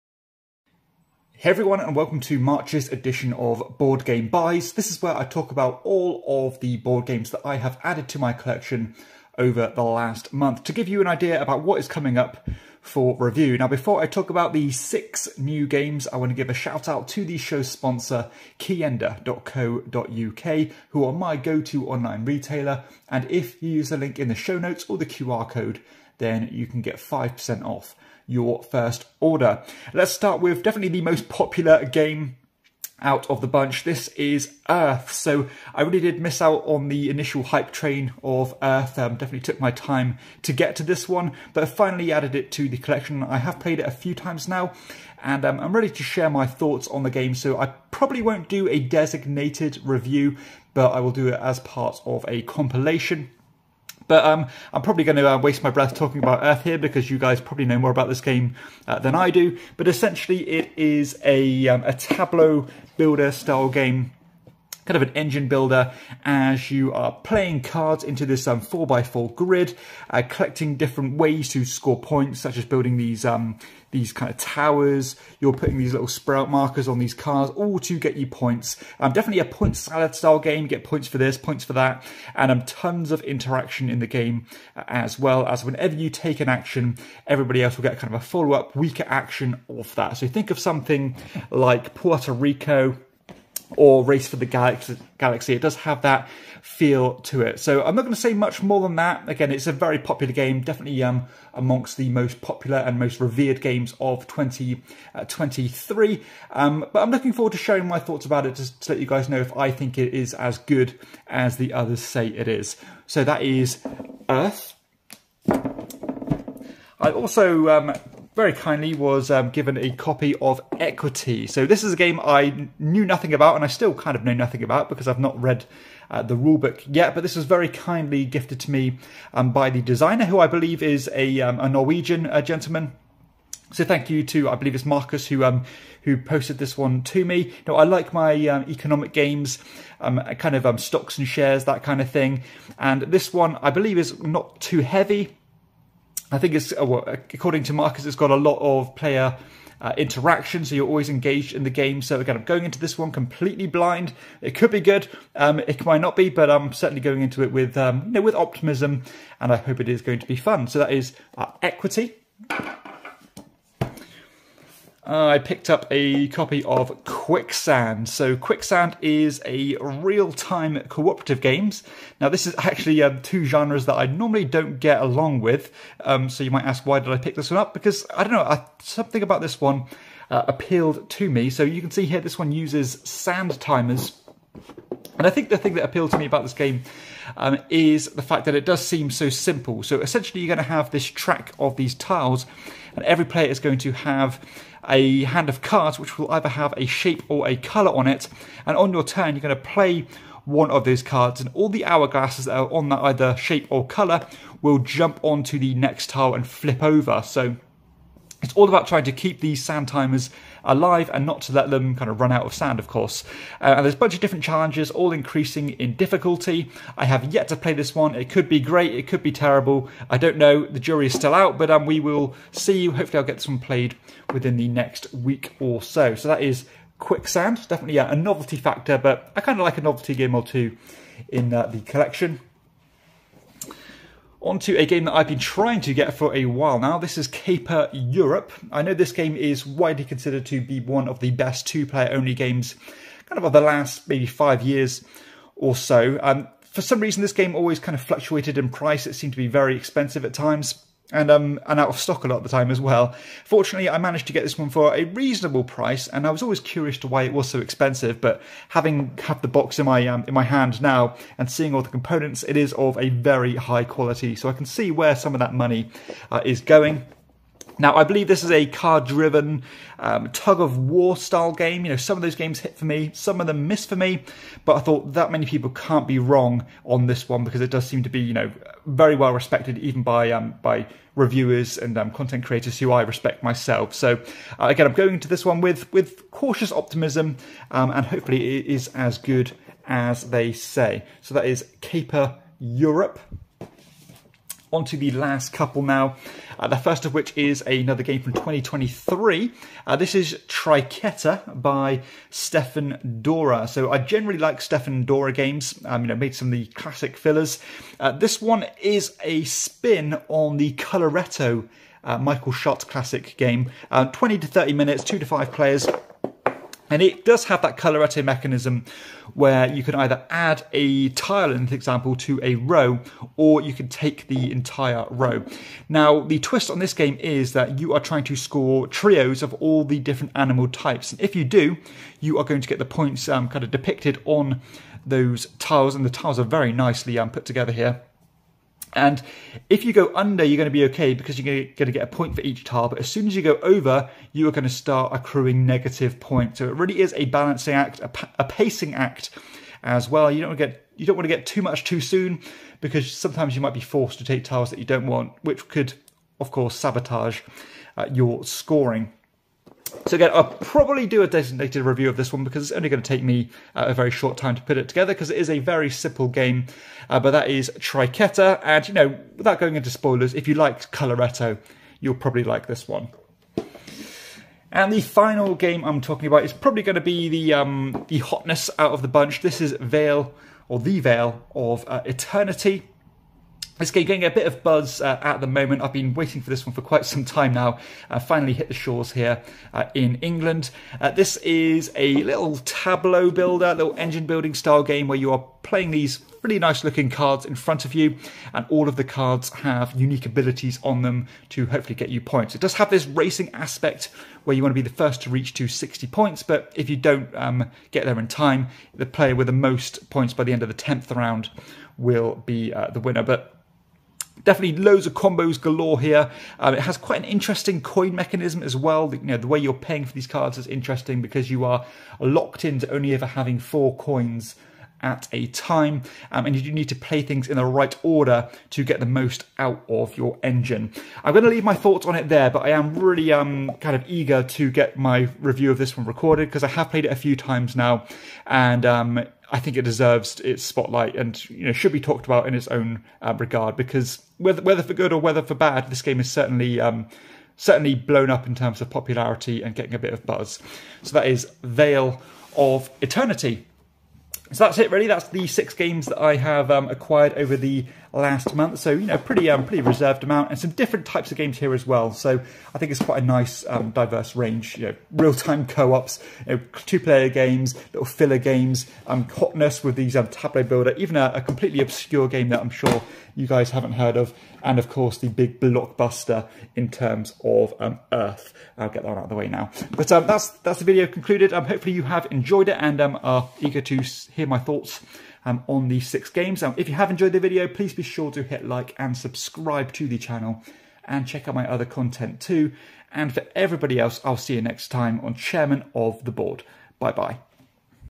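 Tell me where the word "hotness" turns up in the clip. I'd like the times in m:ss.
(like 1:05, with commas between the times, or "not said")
6:18, 7:49.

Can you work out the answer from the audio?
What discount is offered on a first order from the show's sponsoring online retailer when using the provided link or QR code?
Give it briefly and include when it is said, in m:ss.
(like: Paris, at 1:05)
5%, at 0:26.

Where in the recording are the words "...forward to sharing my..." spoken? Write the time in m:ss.
1:47.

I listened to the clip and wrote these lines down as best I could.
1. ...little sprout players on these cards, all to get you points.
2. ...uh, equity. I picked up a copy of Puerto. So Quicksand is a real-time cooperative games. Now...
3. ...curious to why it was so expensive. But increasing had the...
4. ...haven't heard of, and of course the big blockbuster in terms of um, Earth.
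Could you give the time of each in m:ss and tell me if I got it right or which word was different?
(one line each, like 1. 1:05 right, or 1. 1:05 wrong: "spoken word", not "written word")
1. 1:15 wrong: "markers", not "players"
2. 2:41 wrong: "Quicksand", not "Puerto"
3. 4:16 wrong: "having", not "increasing"
4. 7:53 right.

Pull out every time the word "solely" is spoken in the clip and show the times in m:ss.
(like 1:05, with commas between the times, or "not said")
not said.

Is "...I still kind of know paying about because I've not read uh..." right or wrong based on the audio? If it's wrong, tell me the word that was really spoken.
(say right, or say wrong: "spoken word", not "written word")
wrong: "nothing", not "paying".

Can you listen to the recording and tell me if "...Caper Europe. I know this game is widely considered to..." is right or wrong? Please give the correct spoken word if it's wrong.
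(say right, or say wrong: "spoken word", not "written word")
right.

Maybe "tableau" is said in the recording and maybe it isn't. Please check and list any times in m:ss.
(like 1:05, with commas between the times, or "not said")
1:01, 6:32, 7:50.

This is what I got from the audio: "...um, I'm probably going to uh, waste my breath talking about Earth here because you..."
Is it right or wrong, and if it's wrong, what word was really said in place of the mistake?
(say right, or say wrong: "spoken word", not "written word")
right.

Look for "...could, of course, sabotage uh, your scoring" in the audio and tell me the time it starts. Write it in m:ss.
5:55.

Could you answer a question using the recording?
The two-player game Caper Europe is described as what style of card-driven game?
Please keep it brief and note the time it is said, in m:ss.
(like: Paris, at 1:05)
tug-of-war, at 4:30.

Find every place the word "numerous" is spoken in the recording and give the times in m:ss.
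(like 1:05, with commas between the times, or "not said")
not said.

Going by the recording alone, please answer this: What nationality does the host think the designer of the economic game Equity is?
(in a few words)
Norwegian.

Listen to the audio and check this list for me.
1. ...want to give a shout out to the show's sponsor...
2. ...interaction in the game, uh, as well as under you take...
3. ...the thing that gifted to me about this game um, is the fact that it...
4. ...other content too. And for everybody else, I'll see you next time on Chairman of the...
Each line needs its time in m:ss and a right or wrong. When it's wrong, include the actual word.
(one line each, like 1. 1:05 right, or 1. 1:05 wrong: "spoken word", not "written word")
1. 0:16 right
2. 1:23 wrong: "whenever", not "under"
3. 3:05 wrong: "appealed", not "gifted"
4. 8:11 right.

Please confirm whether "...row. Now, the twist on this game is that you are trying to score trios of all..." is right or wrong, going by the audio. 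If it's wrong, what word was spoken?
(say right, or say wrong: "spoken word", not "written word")
right.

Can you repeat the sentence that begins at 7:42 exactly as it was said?
So I think it's quite a nice um, diverse range.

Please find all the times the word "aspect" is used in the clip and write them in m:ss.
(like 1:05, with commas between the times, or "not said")
6:43.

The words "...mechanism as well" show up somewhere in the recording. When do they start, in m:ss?
6:58.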